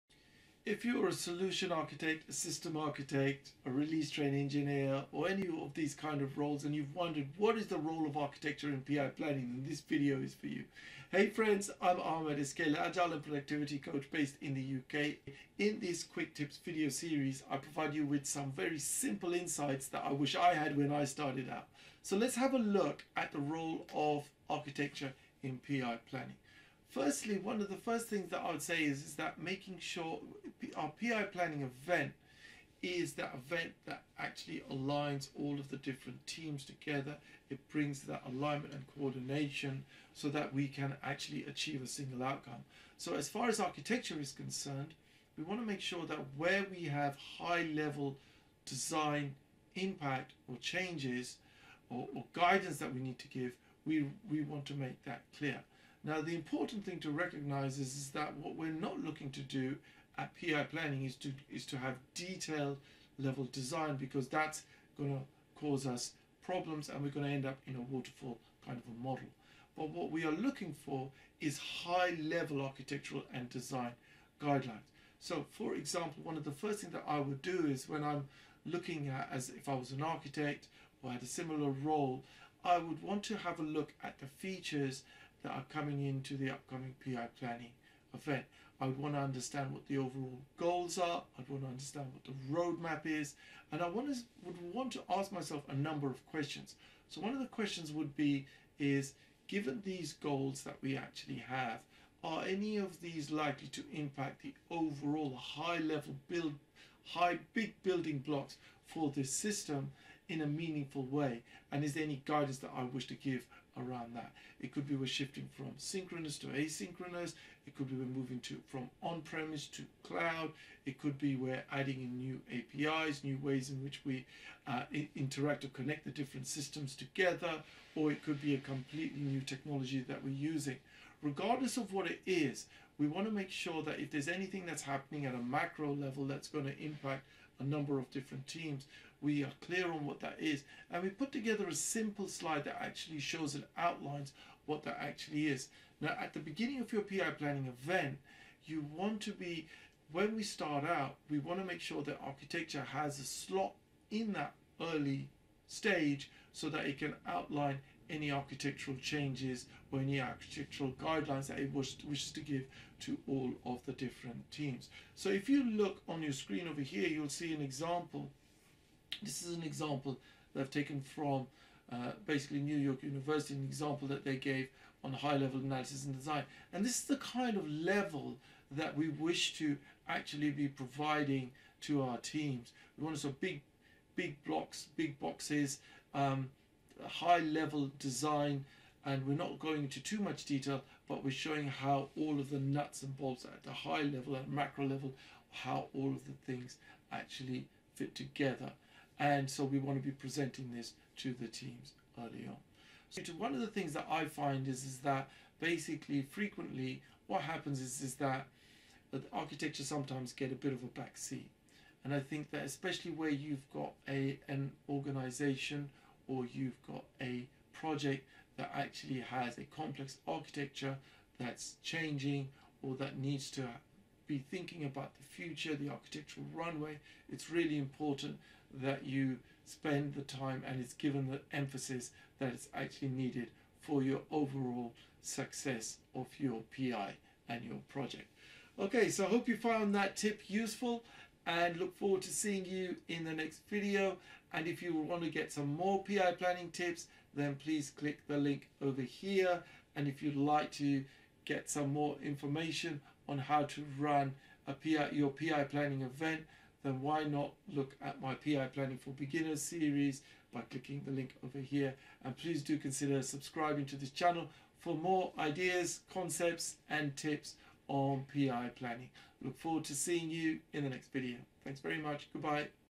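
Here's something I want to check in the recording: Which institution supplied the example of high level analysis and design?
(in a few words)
New York University.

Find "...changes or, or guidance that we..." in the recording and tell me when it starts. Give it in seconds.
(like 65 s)
50 s.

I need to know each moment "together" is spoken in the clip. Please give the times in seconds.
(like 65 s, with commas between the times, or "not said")
36 s, 126 s, 141 s, 198 s.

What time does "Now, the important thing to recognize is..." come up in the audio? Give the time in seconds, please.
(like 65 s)
56 s.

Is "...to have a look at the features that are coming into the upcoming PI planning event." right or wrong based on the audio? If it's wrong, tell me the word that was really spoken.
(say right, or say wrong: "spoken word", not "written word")
right.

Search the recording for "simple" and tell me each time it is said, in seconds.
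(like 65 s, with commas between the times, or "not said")
18 s, 141 s.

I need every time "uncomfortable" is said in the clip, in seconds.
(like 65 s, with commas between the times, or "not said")
not said.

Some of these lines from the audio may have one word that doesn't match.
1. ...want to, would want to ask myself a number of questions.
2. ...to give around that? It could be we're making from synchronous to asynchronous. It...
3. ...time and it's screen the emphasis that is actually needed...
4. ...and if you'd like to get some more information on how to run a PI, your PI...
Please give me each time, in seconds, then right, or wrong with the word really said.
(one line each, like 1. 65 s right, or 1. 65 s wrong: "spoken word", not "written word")
1. 93 s right
2. 113 s wrong: "shifting", not "making"
3. 230 s wrong: "given", not "screen"
4. 249 s right.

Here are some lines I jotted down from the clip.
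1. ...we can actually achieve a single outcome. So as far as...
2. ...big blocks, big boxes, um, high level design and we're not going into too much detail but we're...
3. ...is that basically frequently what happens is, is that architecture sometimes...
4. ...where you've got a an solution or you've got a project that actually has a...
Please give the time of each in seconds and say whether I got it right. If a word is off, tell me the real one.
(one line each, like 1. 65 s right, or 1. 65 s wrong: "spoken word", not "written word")
1. 40 s right
2. 184 s right
3. 204 s right
4. 213 s wrong: "organization", not "solution".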